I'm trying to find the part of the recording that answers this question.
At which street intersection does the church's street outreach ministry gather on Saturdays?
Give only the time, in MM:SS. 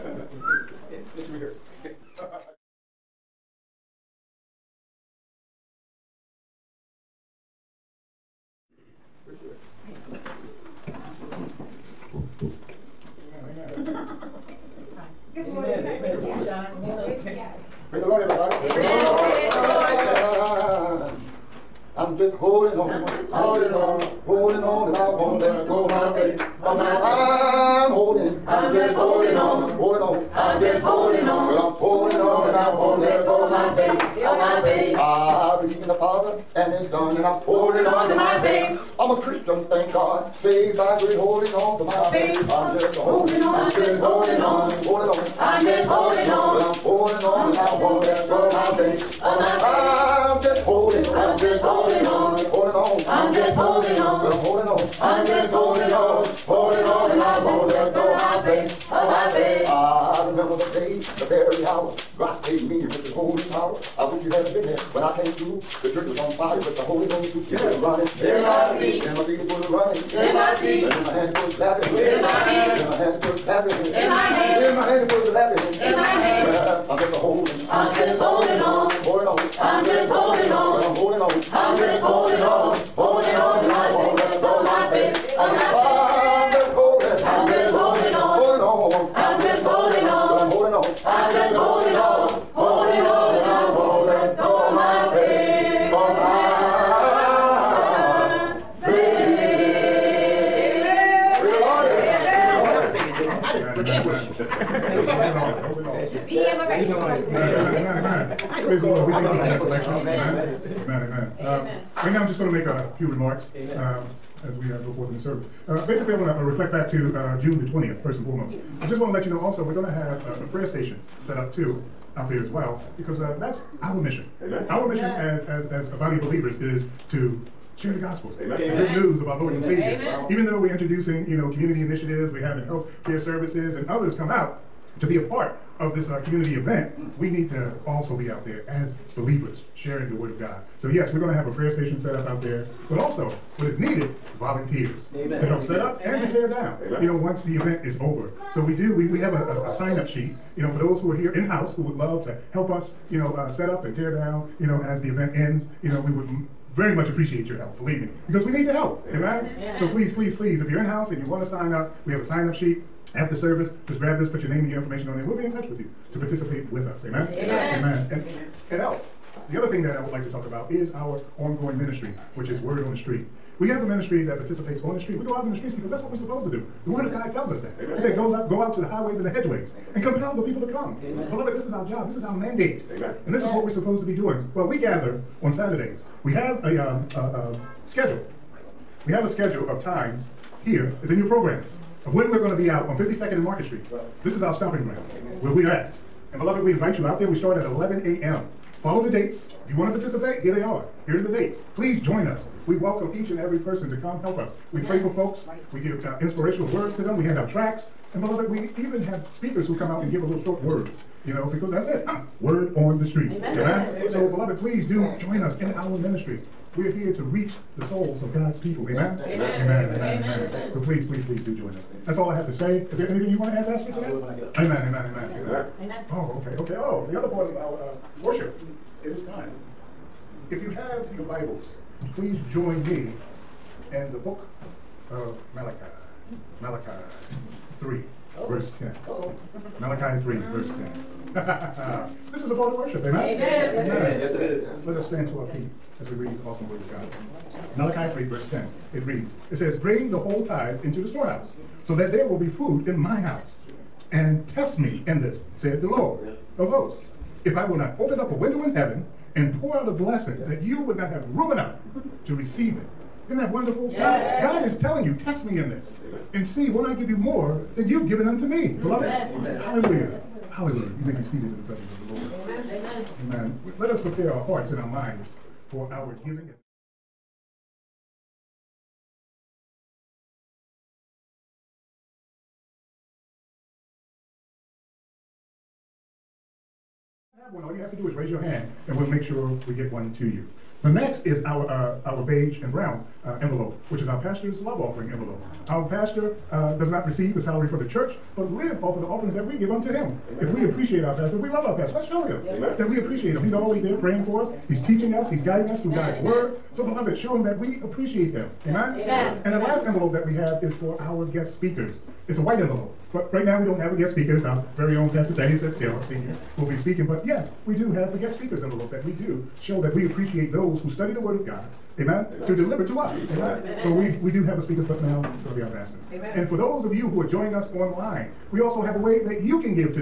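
03:12.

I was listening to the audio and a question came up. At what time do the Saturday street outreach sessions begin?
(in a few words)
11 a.m.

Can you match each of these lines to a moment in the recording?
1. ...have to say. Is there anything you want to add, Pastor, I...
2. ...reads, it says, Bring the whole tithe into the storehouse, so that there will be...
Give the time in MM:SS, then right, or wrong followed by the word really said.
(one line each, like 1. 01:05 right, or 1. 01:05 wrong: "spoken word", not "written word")
1. 03:42 right
2. 04:09 right.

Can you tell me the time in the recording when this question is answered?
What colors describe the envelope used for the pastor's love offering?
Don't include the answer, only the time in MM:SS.
04:52.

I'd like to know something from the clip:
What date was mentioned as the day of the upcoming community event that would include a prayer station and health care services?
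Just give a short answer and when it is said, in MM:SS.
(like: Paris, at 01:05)
June 20th, at 01:57.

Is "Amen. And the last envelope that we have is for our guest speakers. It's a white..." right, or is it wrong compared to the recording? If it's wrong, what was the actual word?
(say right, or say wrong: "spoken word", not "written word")
right.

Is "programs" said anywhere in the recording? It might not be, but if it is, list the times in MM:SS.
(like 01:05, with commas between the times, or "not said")
03:11.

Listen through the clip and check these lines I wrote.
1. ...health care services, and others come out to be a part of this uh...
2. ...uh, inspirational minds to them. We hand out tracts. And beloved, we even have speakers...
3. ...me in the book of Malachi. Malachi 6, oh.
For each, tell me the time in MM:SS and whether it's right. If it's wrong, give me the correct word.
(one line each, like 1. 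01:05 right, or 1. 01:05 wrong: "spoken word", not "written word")
1. 02:12 right
2. 03:26 wrong: "words", not "minds"
3. 03:52 wrong: "3", not "6".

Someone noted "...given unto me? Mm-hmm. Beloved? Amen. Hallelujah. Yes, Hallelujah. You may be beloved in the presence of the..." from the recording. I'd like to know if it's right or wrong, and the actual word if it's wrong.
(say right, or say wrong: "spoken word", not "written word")
wrong: "seated", not "beloved".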